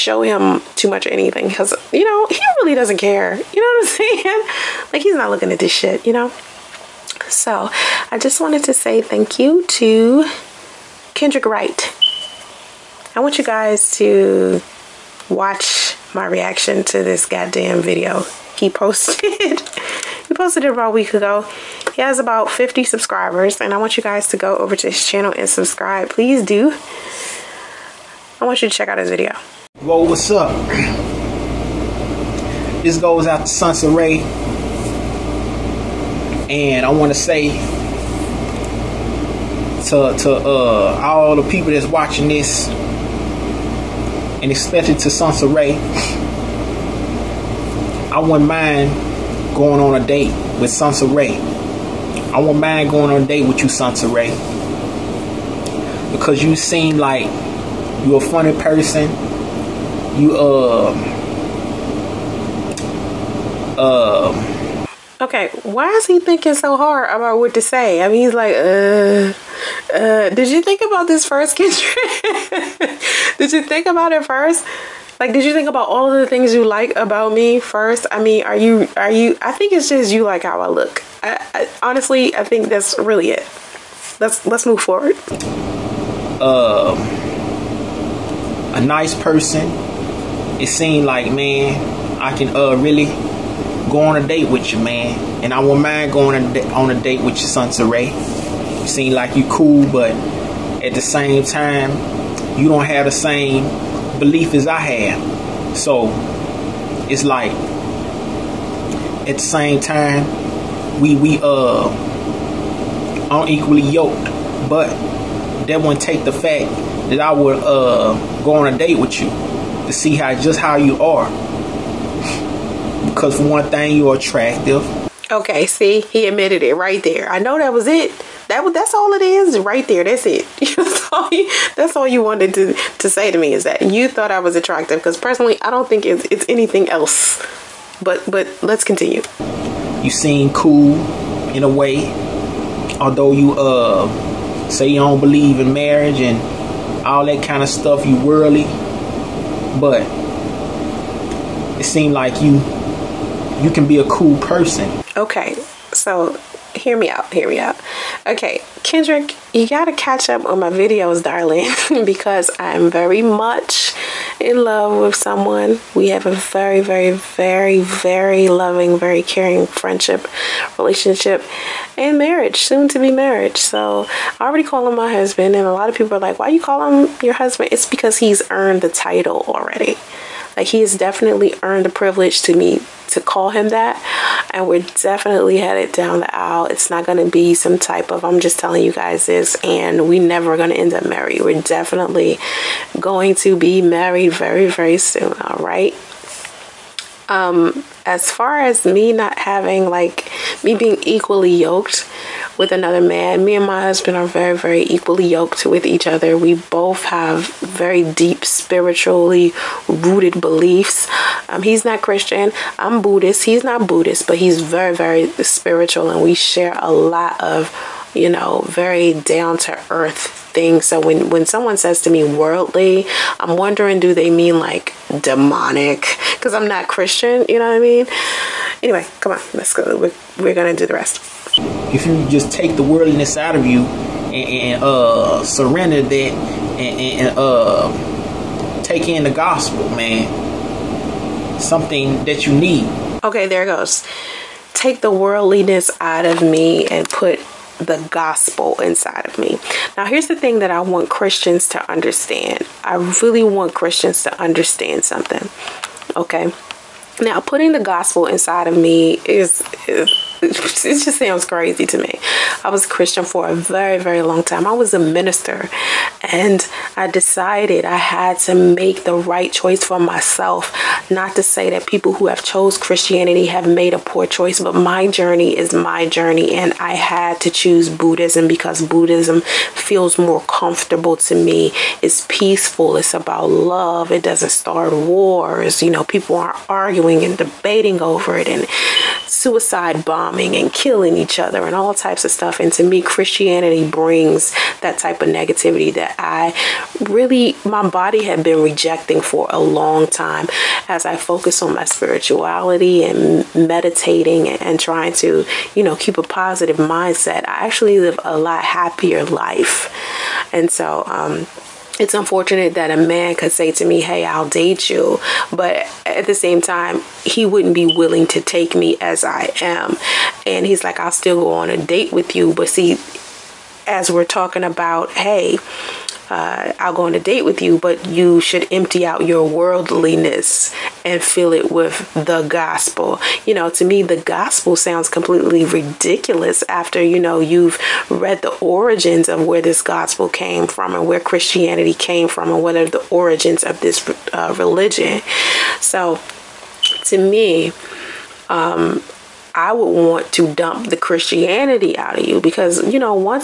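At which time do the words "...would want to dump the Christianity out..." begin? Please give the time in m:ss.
5:49.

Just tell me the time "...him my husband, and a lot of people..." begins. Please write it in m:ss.
2:54.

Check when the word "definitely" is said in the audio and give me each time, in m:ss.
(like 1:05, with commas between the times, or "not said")
3:00, 3:05, 3:11.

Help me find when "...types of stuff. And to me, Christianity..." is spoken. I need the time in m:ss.
4:51.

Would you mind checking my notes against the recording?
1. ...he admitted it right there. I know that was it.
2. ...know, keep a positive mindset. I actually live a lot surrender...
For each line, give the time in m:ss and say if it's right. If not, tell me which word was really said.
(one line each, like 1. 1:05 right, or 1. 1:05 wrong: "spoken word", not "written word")
1. 2:06 right
2. 5:05 wrong: "happier", not "surrender".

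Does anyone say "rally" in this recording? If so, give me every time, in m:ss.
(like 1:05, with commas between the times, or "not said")
not said.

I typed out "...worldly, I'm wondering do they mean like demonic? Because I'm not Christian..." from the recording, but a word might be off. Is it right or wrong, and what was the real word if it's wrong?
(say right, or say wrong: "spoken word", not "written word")
right.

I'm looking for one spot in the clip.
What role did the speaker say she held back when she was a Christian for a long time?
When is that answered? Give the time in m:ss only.
4:24.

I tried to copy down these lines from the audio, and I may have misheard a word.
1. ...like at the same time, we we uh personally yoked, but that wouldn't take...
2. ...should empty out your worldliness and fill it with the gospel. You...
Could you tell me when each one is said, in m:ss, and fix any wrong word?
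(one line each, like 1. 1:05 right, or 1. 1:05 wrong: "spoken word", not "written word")
1. 1:47 wrong: "unequally", not "personally"
2. 5:28 right.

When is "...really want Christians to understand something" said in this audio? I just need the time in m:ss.
4:13.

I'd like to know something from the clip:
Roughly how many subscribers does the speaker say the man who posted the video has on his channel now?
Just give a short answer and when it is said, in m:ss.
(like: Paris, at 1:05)
50, at 0:22.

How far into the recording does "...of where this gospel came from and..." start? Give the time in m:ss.
5:39.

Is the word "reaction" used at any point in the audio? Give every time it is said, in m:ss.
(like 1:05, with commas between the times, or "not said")
0:16.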